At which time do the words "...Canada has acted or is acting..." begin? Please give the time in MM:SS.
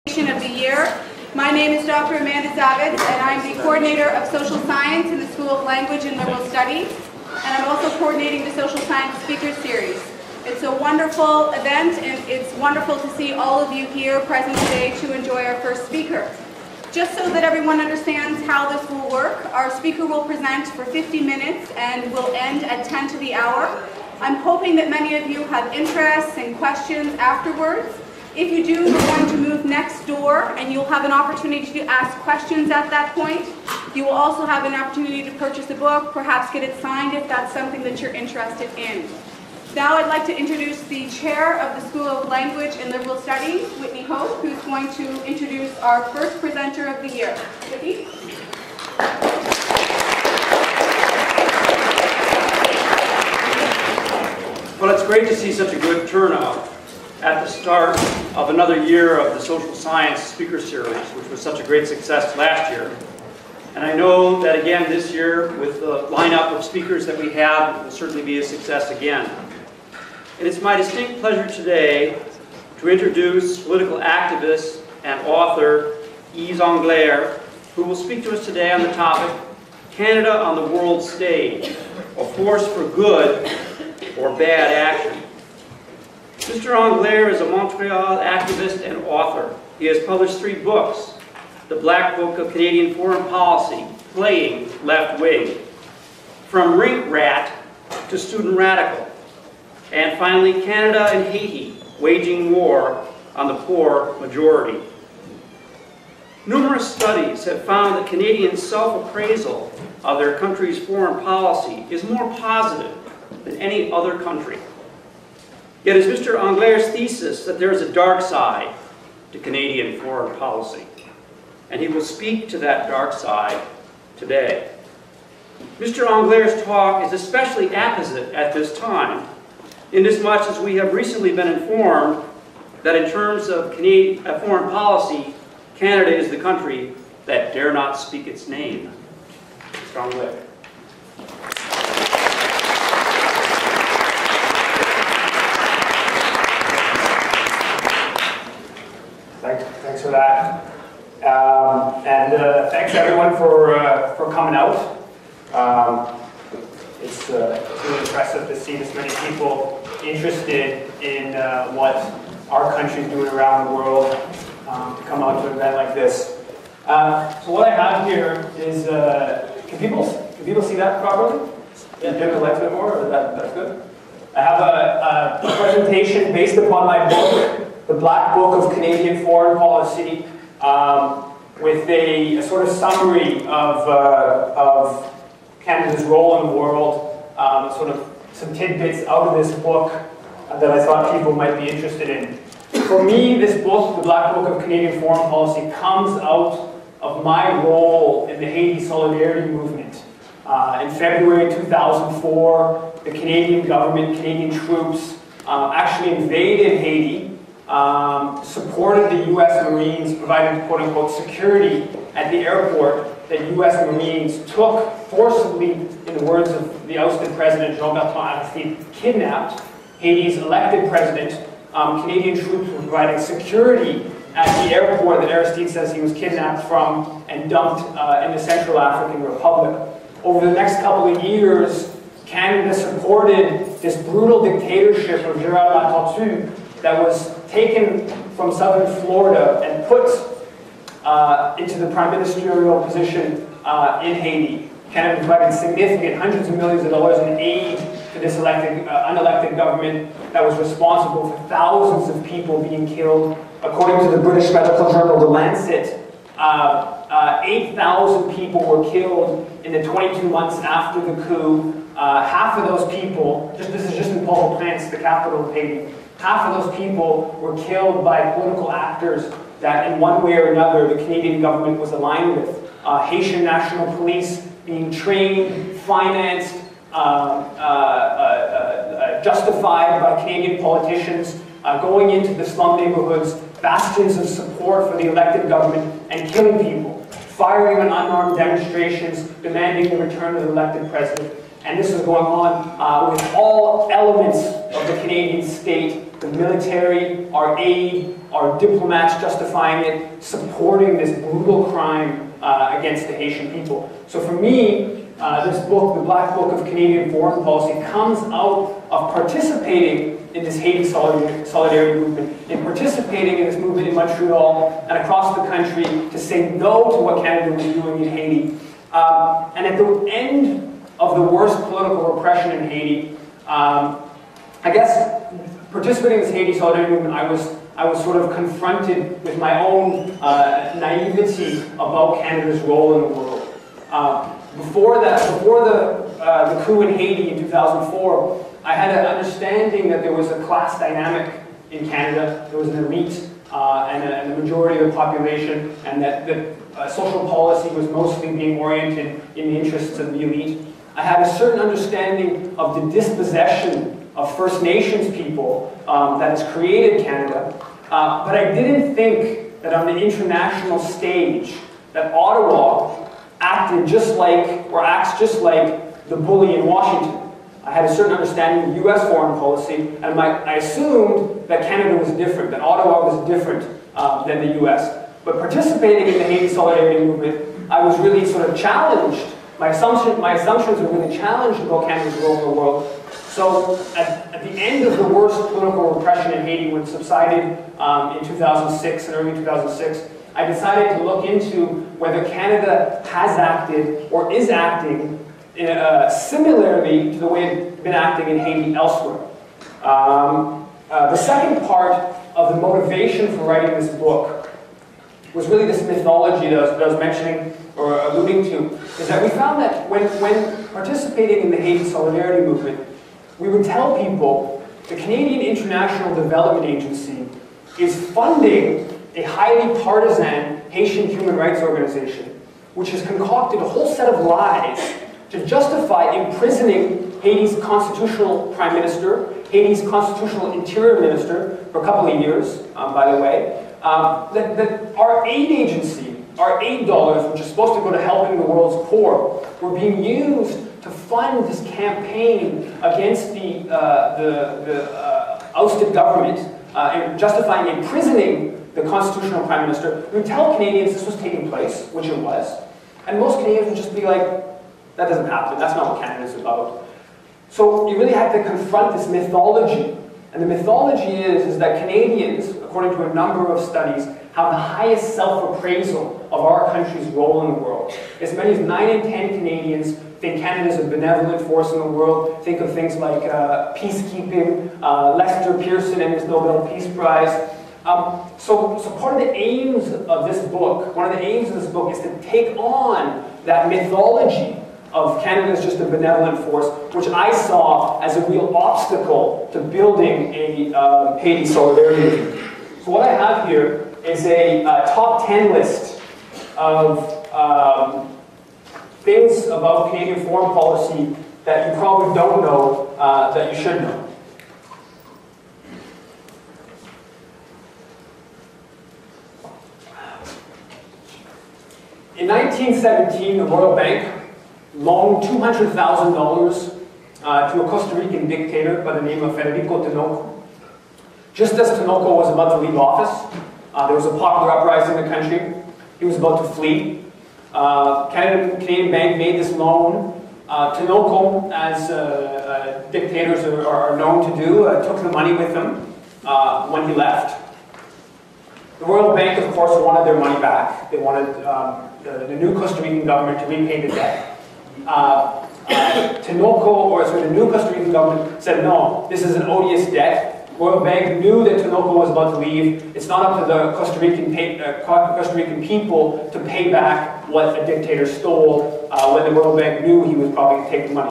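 06:32.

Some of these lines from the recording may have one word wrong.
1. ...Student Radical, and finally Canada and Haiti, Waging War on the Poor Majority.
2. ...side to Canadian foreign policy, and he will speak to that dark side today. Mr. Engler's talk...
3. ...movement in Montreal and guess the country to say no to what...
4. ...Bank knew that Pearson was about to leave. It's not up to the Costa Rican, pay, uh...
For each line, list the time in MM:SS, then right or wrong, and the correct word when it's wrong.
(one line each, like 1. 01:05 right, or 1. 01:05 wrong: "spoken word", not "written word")
1. 01:38 right
2. 01:58 right
3. 05:13 wrong: "across", not "guess"
4. 09:10 wrong: "Tinoco", not "Pearson".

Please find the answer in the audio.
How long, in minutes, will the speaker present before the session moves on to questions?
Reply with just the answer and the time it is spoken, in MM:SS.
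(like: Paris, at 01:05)
50, at 00:20.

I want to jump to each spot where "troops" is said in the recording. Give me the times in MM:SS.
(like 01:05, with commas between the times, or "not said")
03:24, 03:42.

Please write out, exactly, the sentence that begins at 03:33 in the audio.
Marines took forcibly, in the words of the ousted president Jean-Bertrand Aristide, kidnapped Haiti's elected president.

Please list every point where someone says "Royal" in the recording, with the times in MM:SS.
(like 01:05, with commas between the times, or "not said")
08:33, 08:58.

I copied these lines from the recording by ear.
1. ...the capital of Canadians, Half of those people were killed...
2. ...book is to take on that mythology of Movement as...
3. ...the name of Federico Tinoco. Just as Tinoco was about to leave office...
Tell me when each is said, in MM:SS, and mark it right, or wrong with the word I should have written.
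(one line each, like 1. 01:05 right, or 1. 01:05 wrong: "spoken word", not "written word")
1. 04:24 wrong: "Haiti", not "Canadians"
2. 08:01 wrong: "Canada", not "Movement"
3. 08:38 right.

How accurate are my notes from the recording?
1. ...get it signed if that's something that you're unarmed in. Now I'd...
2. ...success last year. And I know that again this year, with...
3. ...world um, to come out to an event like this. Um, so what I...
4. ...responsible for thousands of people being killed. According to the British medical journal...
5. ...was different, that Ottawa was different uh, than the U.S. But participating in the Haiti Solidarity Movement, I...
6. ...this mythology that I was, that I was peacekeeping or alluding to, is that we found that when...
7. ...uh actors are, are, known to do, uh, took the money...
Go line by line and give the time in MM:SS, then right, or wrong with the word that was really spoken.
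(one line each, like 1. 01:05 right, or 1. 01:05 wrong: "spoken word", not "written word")
1. 00:36 wrong: "interested", not "unarmed"
2. 01:01 right
3. 02:43 right
4. 04:10 right
5. 06:11 right
6. 06:45 wrong: "mentioning", not "peacekeeping"
7. 08:52 wrong: "dictators", not "actors".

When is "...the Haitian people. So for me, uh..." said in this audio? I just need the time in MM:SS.
05:03.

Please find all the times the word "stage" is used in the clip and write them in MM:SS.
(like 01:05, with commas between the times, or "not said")
01:21, 06:00.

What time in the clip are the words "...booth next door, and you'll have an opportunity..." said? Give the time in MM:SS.
00:29.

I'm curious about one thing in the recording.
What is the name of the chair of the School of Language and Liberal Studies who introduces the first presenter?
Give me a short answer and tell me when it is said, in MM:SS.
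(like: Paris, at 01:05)
Whitney Hope, at 00:43.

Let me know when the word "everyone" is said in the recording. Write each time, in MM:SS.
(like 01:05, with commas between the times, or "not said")
00:17, 02:32.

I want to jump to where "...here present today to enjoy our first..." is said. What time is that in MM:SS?
00:13.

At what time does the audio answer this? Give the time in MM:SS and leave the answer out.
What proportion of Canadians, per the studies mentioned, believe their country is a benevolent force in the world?
07:48.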